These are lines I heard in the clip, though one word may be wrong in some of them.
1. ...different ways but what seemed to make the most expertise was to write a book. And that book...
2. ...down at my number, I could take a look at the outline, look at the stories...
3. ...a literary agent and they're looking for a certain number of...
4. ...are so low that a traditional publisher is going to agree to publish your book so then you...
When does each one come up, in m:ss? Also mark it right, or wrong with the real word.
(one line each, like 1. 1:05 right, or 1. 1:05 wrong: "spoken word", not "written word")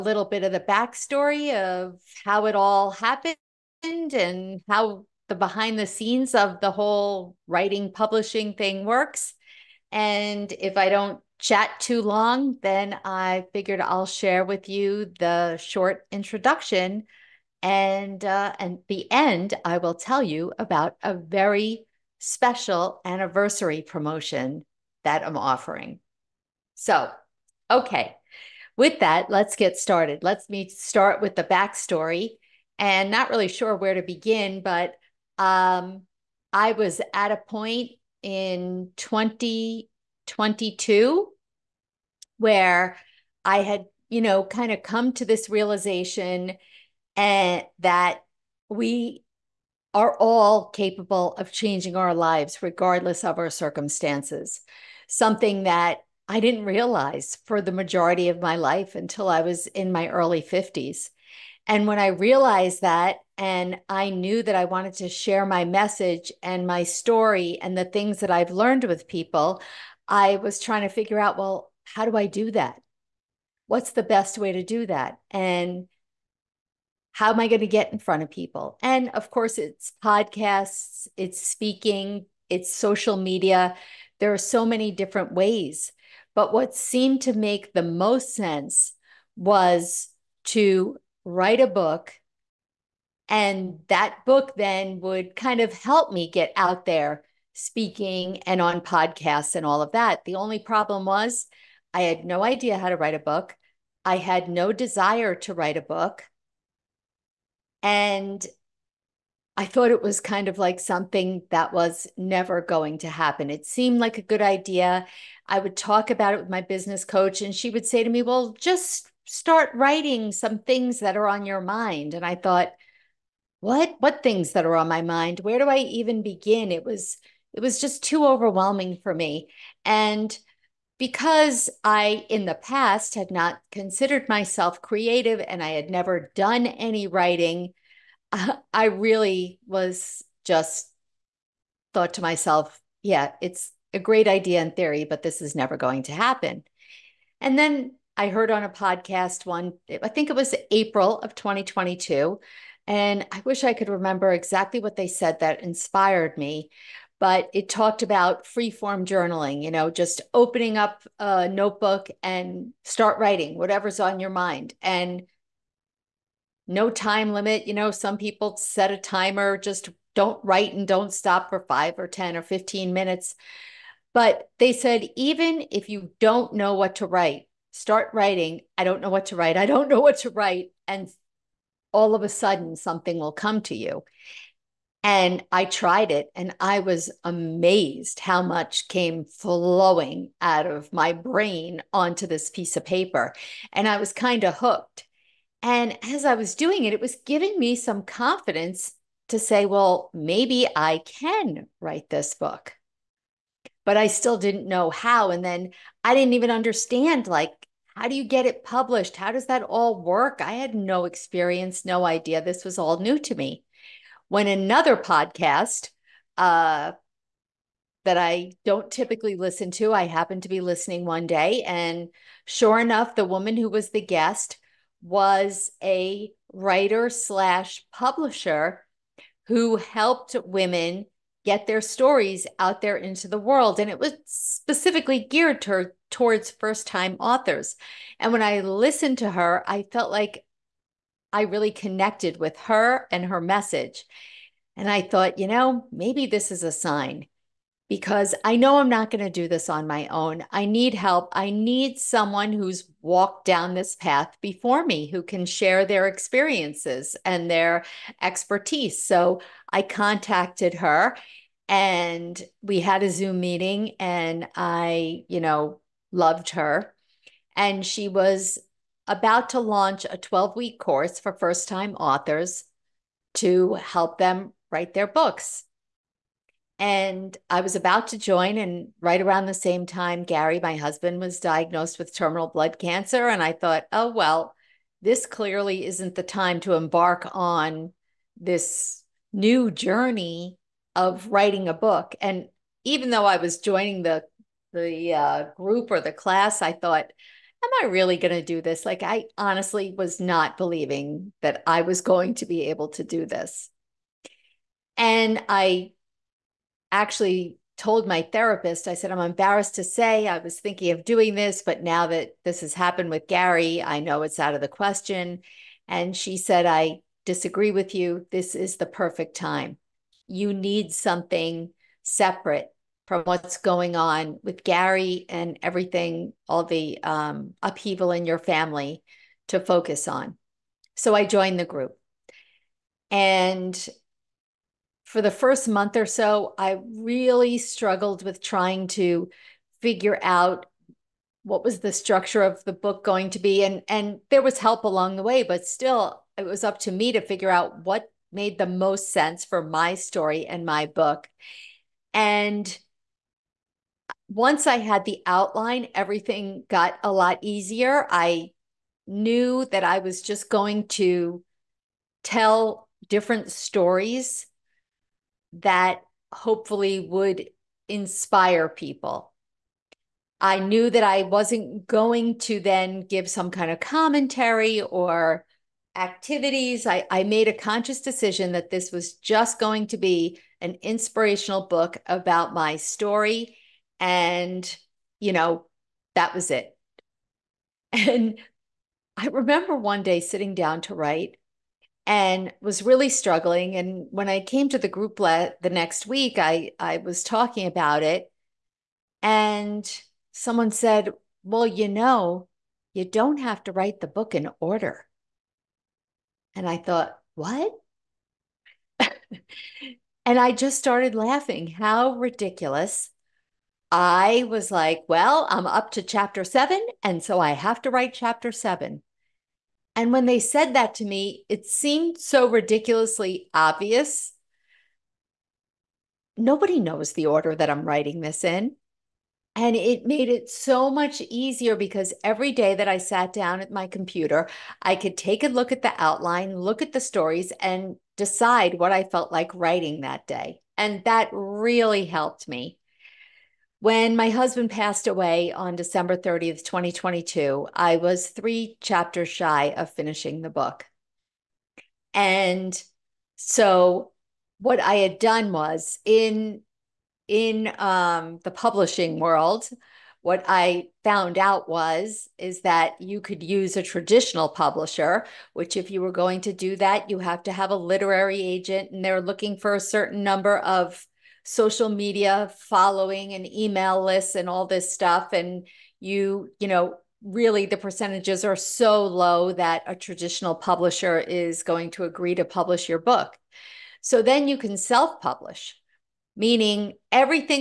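1. 1:24 wrong: "sense", not "expertise"
2. 7:13 wrong: "computer", not "number"
3. 7:47 right
4. 7:58 right.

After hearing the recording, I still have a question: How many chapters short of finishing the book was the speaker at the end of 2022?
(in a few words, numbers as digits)
3.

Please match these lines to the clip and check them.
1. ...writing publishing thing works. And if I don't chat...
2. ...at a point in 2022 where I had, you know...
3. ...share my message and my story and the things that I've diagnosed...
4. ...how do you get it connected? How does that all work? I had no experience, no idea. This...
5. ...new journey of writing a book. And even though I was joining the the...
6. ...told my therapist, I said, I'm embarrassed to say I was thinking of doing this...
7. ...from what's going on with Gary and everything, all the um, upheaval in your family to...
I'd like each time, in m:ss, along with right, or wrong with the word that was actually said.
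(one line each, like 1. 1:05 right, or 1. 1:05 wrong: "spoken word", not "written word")
1. 0:07 right
2. 0:37 right
3. 1:05 wrong: "learned", not "diagnosed"
4. 3:27 wrong: "published", not "connected"
5. 4:49 right
6. 5:07 right
7. 5:23 right.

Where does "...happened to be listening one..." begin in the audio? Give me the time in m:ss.
3:40.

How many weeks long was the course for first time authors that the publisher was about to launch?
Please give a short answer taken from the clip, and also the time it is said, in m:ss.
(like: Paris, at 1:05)
12, at 4:30.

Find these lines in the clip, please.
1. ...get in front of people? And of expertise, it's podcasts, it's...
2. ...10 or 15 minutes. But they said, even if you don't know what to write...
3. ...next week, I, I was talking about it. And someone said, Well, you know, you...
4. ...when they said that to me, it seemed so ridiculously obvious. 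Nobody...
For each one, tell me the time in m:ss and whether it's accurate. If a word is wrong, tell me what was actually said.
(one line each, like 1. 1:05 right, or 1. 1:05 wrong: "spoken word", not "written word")
1. 1:17 wrong: "course", not "expertise"
2. 2:52 right
3. 6:35 right
4. 7:00 right.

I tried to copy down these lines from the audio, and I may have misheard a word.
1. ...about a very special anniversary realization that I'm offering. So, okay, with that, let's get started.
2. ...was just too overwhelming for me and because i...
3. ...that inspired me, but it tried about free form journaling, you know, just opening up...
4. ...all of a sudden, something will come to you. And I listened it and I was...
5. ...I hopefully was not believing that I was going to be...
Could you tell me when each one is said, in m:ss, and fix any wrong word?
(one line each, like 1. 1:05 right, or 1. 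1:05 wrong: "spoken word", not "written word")
1. 0:20 wrong: "promotion", not "realization"
2. 2:07 right
3. 2:35 wrong: "talked", not "tried"
4. 3:01 wrong: "tried", not "listened"
5. 4:59 wrong: "honestly", not "hopefully".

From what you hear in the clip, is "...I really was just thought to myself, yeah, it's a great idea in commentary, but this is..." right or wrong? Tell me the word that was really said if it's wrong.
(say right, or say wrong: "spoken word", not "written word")
wrong: "theory", not "commentary".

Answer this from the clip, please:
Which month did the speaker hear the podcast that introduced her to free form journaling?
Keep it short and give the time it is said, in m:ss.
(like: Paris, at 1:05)
April, at 2:30.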